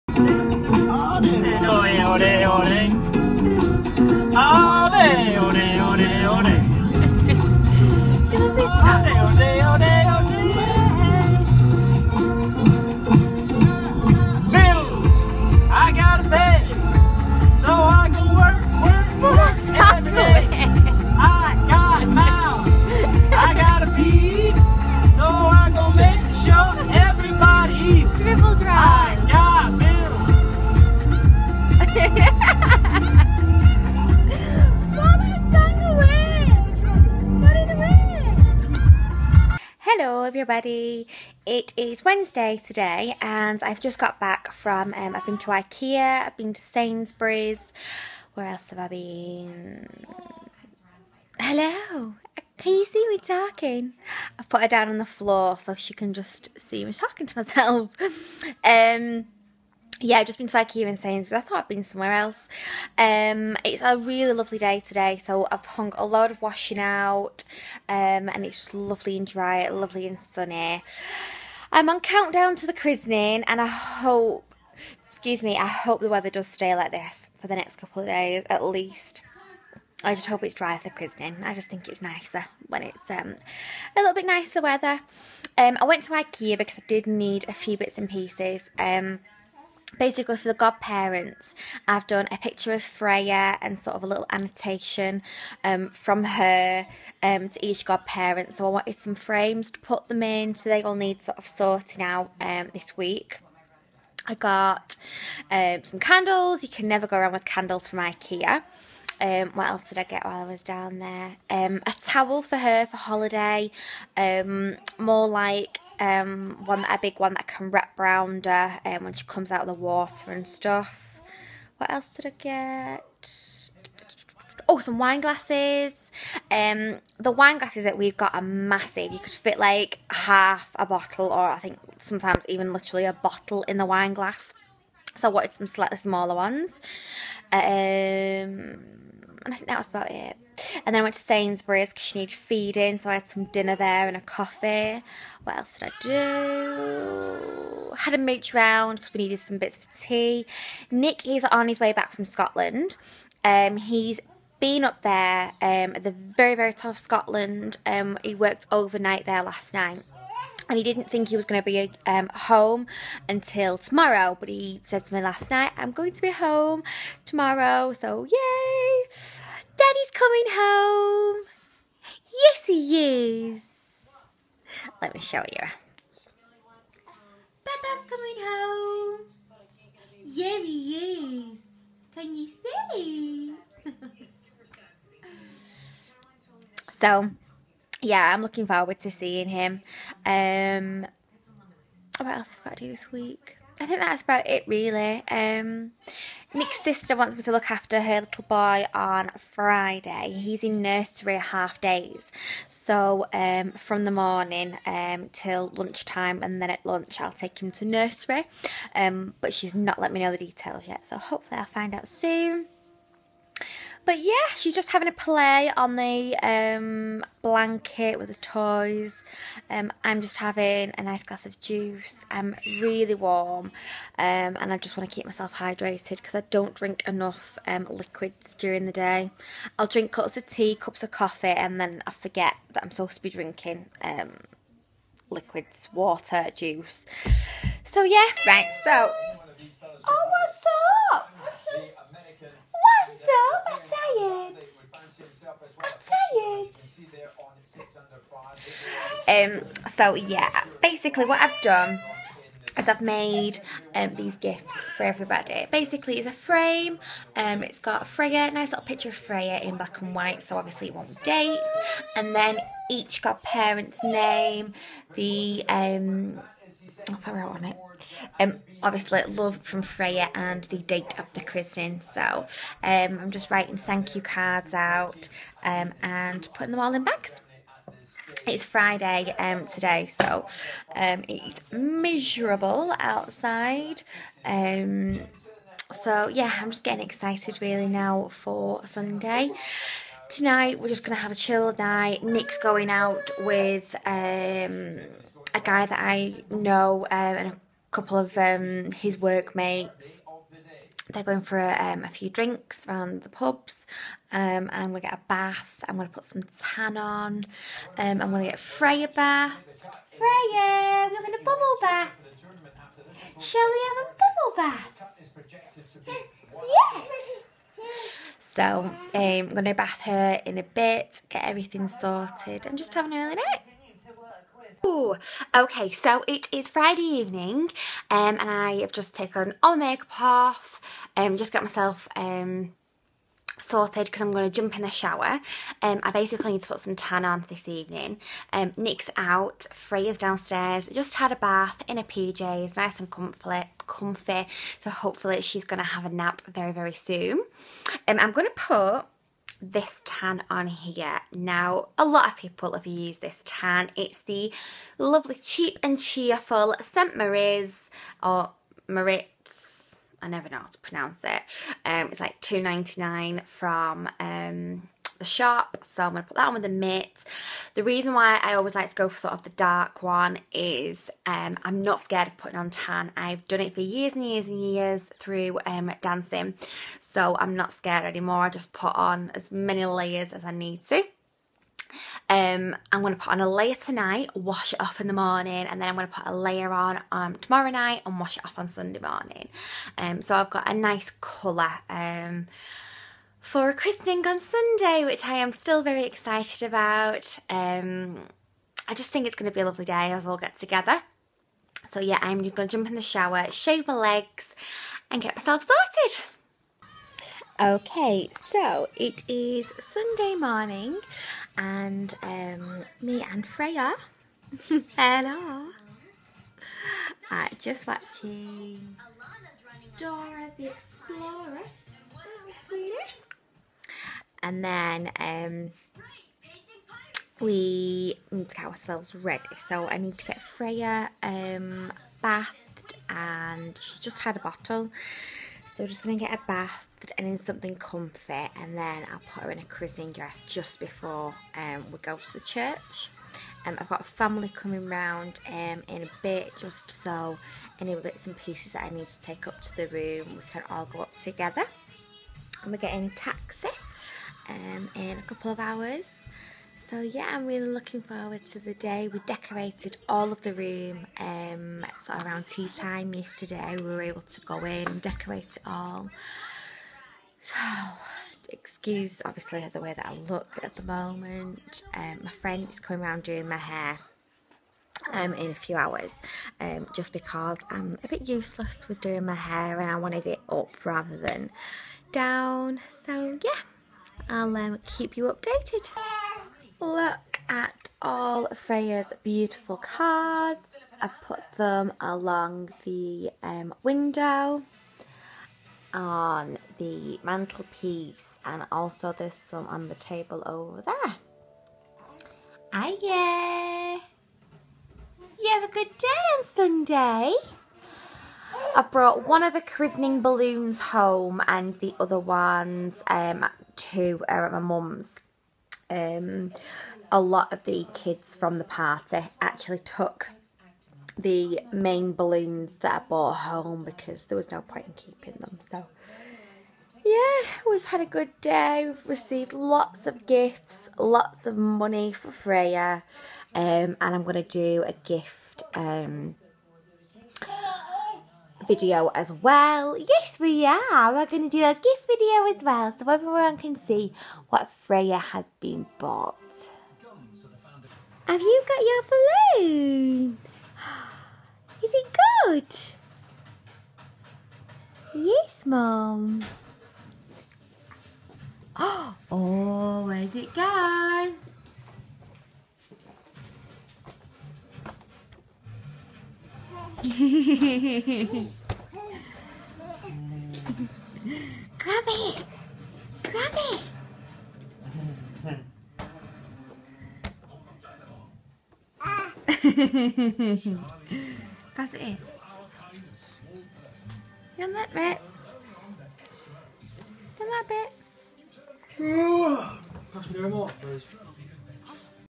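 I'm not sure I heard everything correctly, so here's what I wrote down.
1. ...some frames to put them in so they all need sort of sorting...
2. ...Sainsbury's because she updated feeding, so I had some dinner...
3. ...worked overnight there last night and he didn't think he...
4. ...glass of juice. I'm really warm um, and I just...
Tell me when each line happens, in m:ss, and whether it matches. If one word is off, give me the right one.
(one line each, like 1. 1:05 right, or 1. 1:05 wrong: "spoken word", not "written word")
1. 1:38 right
2. 2:21 wrong: "needed", not "updated"
3. 2:38 right
4. 3:41 right.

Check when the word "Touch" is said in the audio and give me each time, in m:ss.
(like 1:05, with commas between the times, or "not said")
9:50.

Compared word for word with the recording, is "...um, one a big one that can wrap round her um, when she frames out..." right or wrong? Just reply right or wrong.
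wrong.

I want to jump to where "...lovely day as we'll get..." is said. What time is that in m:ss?
6:39.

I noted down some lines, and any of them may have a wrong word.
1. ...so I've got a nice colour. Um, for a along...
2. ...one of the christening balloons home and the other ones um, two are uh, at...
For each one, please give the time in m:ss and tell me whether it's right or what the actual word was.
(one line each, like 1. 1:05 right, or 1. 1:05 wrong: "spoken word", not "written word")
1. 6:30 wrong: "christening", not "along"
2. 8:29 right.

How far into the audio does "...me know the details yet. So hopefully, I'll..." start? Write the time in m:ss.
3:30.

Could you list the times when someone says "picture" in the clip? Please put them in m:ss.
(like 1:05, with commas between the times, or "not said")
1:32, 4:18.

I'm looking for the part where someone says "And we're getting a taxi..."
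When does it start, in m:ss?
7:32.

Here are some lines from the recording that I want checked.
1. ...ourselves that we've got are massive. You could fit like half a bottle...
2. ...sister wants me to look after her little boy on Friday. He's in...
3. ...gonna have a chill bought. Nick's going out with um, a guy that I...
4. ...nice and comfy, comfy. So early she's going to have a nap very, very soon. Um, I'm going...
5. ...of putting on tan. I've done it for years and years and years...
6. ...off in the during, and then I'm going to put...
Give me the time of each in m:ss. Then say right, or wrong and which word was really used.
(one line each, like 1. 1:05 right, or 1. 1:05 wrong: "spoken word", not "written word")
1. 2:07 wrong: "glasses", not "ourselves"
2. 3:16 right
3. 4:51 wrong: "night", not "bought"
4. 5:42 wrong: "hopefully", not "early"
5. 6:12 right
6. 6:24 wrong: "morning", not "during".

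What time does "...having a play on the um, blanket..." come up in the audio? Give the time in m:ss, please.
3:34.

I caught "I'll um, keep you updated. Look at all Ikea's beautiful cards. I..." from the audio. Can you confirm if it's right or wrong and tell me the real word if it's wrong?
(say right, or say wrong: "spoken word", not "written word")
wrong: "Freya", not "Ikea".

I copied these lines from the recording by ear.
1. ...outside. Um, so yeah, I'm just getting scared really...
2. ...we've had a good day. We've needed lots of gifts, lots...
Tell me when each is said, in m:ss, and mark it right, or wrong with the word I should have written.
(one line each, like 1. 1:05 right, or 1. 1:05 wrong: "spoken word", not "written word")
1. 4:42 wrong: "excited", not "scared"
2. 8:47 wrong: "received", not "needed".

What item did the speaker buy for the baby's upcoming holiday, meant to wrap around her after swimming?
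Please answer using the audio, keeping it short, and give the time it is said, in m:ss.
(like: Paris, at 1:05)
A towel, at 1:51.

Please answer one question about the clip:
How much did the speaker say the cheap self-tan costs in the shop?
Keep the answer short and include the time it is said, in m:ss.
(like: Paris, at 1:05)
2.99, at 6:02.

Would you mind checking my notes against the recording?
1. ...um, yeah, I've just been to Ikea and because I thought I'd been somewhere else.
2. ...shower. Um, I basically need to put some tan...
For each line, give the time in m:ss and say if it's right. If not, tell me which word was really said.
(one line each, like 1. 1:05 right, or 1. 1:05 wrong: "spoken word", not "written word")
1. 0:58 right
2. 5:34 right.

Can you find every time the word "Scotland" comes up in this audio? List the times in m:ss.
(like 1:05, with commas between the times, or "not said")
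2:32, 2:36.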